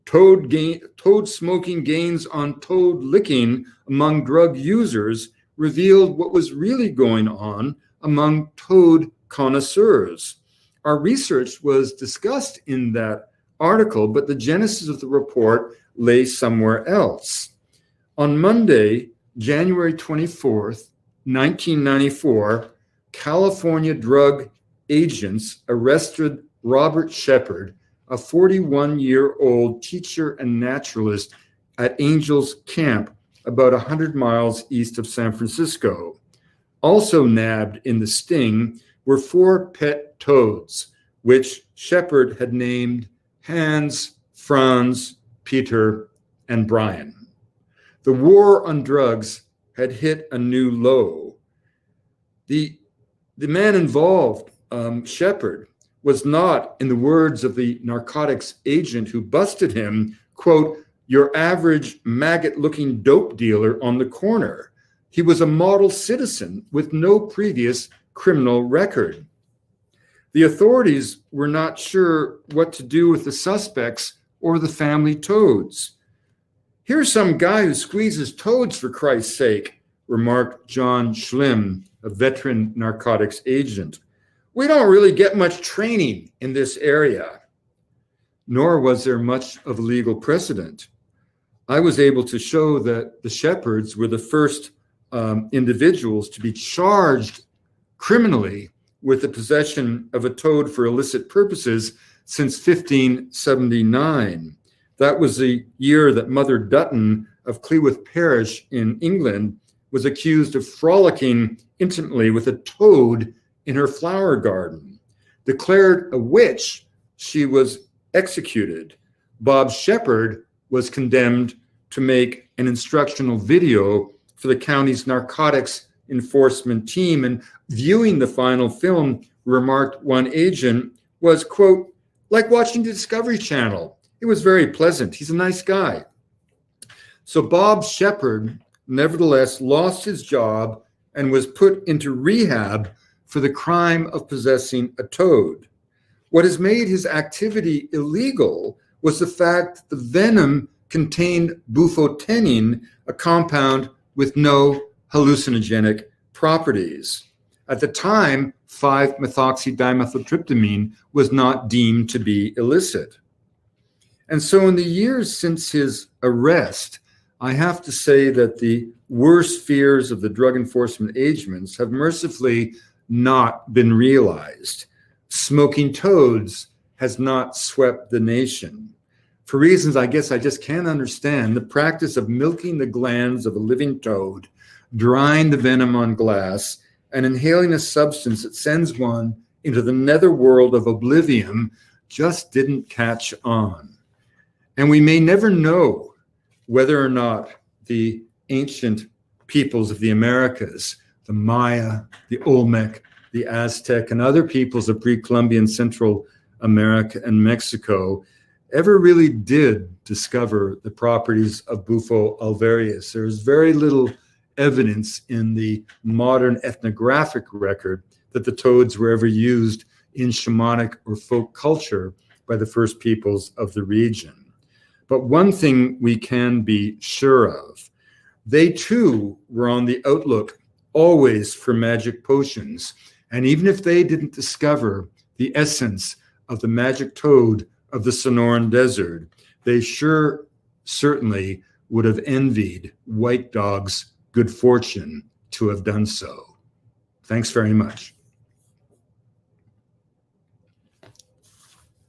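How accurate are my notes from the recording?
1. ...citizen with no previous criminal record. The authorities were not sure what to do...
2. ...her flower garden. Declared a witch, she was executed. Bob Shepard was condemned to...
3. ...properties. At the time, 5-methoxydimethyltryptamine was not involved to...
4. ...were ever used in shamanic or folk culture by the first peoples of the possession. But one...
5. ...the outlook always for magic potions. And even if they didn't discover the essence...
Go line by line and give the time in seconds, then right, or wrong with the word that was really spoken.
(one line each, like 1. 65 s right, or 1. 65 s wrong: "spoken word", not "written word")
1. 65 s right
2. 113 s right
3. 156 s wrong: "deemed", not "involved"
4. 218 s wrong: "region", not "possession"
5. 229 s right.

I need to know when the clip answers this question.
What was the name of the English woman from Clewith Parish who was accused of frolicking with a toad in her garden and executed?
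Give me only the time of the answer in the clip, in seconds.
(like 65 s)
106 s.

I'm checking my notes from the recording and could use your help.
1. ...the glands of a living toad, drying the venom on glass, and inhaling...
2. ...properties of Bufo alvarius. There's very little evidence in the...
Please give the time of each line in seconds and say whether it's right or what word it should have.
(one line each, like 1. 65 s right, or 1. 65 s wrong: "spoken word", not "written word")
1. 182 s right
2. 210 s right.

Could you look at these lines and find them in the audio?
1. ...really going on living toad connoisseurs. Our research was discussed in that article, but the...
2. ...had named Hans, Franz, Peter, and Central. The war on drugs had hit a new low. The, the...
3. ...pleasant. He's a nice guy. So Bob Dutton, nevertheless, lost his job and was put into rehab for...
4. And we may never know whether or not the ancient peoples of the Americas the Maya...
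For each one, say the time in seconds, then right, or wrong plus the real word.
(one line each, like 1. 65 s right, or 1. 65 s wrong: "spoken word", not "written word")
1. 6 s wrong: "among", not "living"
2. 42 s wrong: "Brian", not "Central"
3. 134 s wrong: "Shepard", not "Dutton"
4. 194 s right.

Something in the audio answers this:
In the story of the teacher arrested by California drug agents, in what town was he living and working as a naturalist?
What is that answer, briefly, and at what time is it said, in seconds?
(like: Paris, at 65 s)
Angels Camp, at 31 s.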